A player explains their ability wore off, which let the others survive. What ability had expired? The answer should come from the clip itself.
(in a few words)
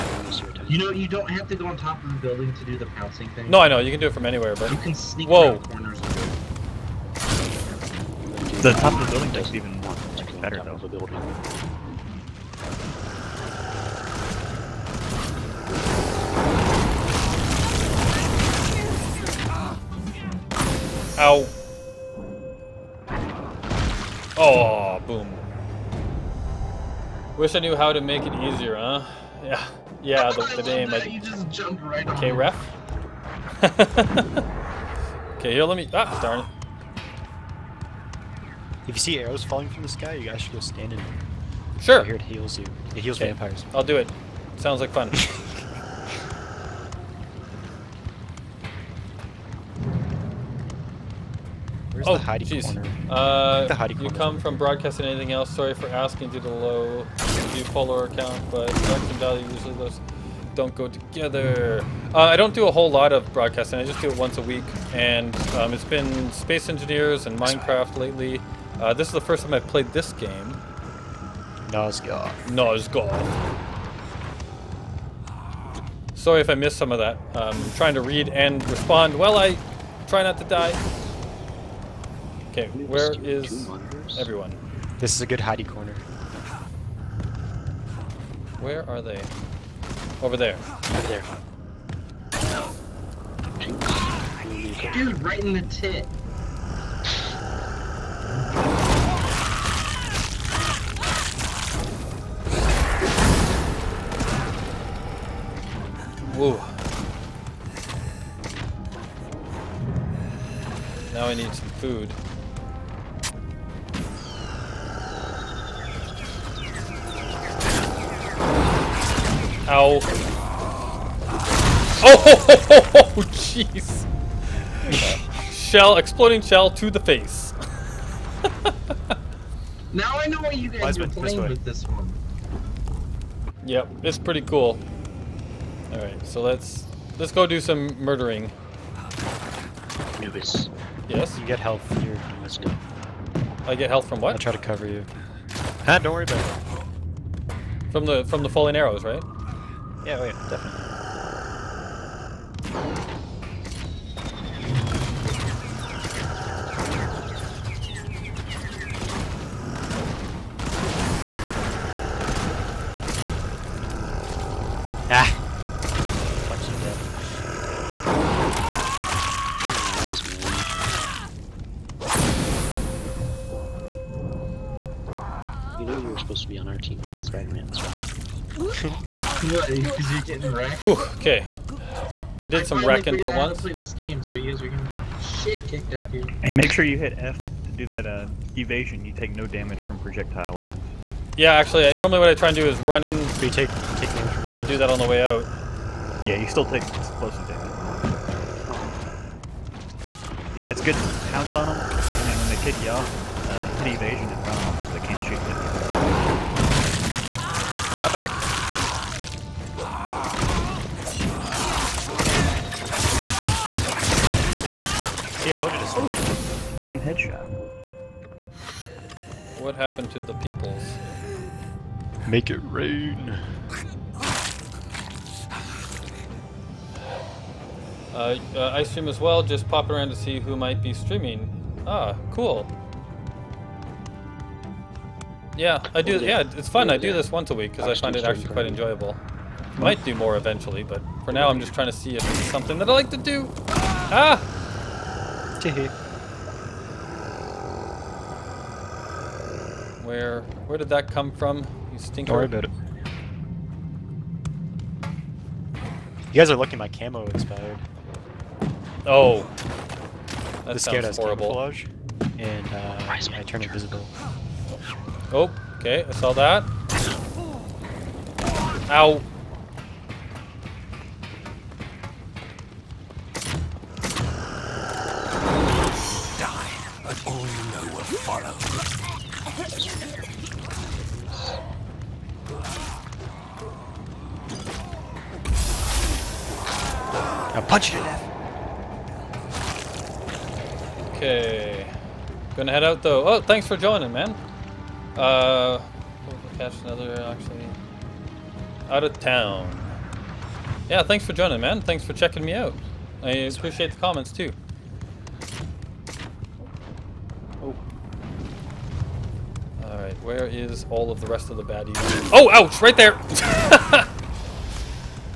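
camo.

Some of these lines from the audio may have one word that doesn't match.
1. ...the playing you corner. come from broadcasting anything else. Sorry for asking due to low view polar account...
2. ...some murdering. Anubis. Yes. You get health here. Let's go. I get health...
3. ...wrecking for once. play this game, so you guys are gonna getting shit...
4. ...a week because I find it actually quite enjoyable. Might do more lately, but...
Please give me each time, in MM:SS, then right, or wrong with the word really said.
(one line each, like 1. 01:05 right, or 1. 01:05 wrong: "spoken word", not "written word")
1. 00:53 wrong: "hiding", not "playing"
2. 02:17 right
3. 03:02 right
4. 03:57 wrong: "eventually", not "lately".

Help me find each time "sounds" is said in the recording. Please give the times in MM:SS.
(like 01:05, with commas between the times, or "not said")
00:44, 04:20.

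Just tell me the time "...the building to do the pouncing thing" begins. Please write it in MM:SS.
00:02.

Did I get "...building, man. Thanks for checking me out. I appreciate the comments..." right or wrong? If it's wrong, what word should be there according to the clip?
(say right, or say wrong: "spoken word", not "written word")
wrong: "joining", not "building".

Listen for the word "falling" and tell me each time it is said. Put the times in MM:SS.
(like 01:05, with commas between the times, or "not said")
00:39, 02:28.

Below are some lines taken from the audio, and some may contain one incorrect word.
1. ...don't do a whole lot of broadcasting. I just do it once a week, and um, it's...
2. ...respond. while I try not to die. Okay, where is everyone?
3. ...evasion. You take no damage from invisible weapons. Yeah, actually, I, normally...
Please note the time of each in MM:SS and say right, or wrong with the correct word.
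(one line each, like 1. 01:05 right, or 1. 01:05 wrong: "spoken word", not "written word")
1. 01:02 right
2. 01:18 right
3. 03:08 wrong: "projectile", not "invisible".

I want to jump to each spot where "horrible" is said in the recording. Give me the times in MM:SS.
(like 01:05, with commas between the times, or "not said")
04:21.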